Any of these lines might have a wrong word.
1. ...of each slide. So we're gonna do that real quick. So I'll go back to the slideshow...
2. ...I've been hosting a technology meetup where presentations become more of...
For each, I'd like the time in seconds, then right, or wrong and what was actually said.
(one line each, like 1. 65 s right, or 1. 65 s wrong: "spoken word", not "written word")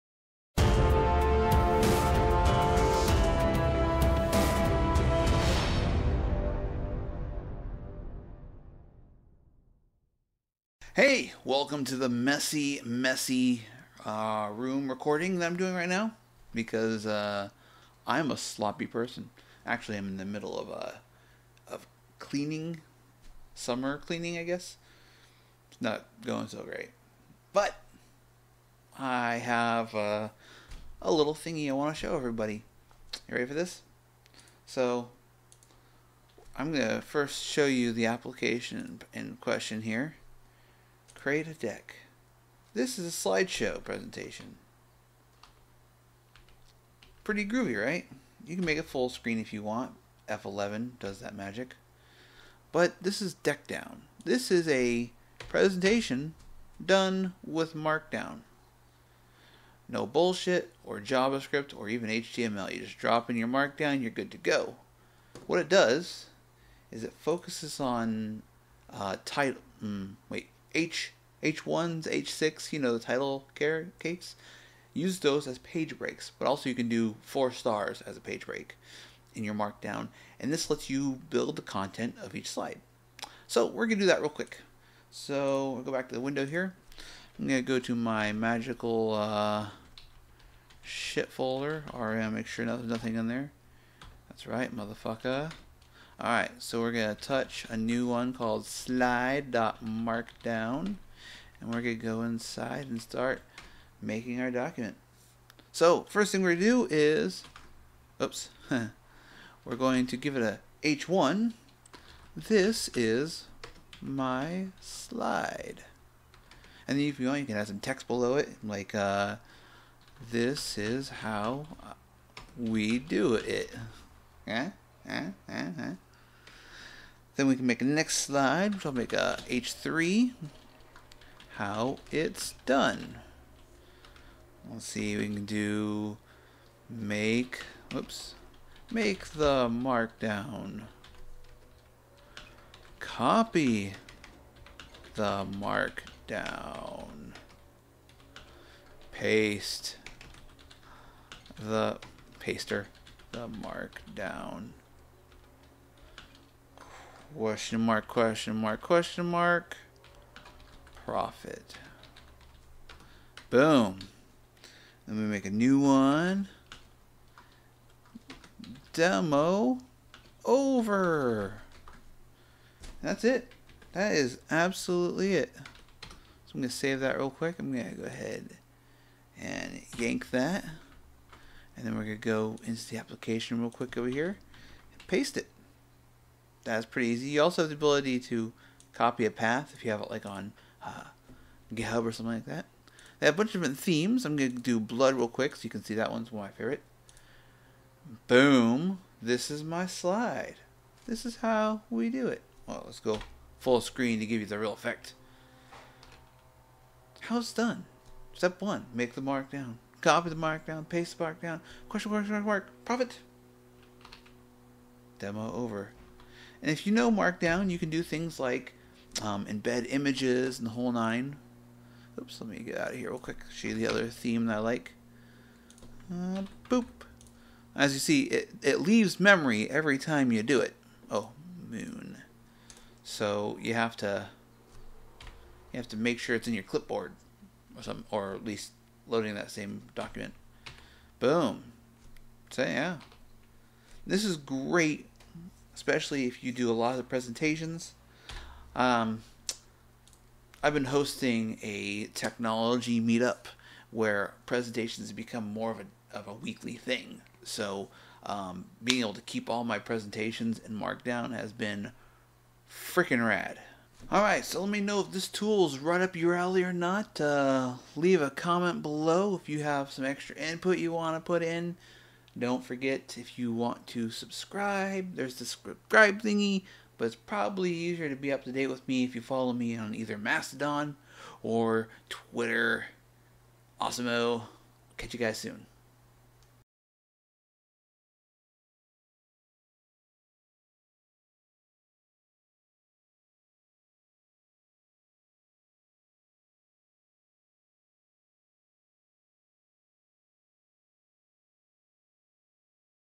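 1. 82 s wrong: "window", not "slideshow"
2. 250 s right.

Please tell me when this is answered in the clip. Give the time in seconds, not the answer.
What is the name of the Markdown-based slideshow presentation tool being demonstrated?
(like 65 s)
53 s.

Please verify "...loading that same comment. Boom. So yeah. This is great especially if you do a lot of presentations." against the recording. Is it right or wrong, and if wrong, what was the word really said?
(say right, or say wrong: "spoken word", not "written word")
wrong: "document", not "comment".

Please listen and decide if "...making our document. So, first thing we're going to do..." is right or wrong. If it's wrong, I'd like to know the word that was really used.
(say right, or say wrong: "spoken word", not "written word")
right.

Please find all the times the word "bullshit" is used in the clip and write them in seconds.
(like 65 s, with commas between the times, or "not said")
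60 s.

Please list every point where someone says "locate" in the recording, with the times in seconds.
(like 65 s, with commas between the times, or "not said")
not said.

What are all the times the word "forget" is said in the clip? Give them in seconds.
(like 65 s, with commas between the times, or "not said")
272 s.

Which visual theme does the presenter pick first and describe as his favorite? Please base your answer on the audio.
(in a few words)
blood.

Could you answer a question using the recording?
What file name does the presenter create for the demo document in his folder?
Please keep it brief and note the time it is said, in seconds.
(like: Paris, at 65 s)
slide.markdown, at 98 s.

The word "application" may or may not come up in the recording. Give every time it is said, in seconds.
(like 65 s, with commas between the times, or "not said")
38 s, 182 s.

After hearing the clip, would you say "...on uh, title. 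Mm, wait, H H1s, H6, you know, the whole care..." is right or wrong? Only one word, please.
wrong.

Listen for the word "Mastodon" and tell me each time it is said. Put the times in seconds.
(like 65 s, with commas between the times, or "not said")
280 s.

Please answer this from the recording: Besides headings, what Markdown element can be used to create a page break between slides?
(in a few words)
four stars.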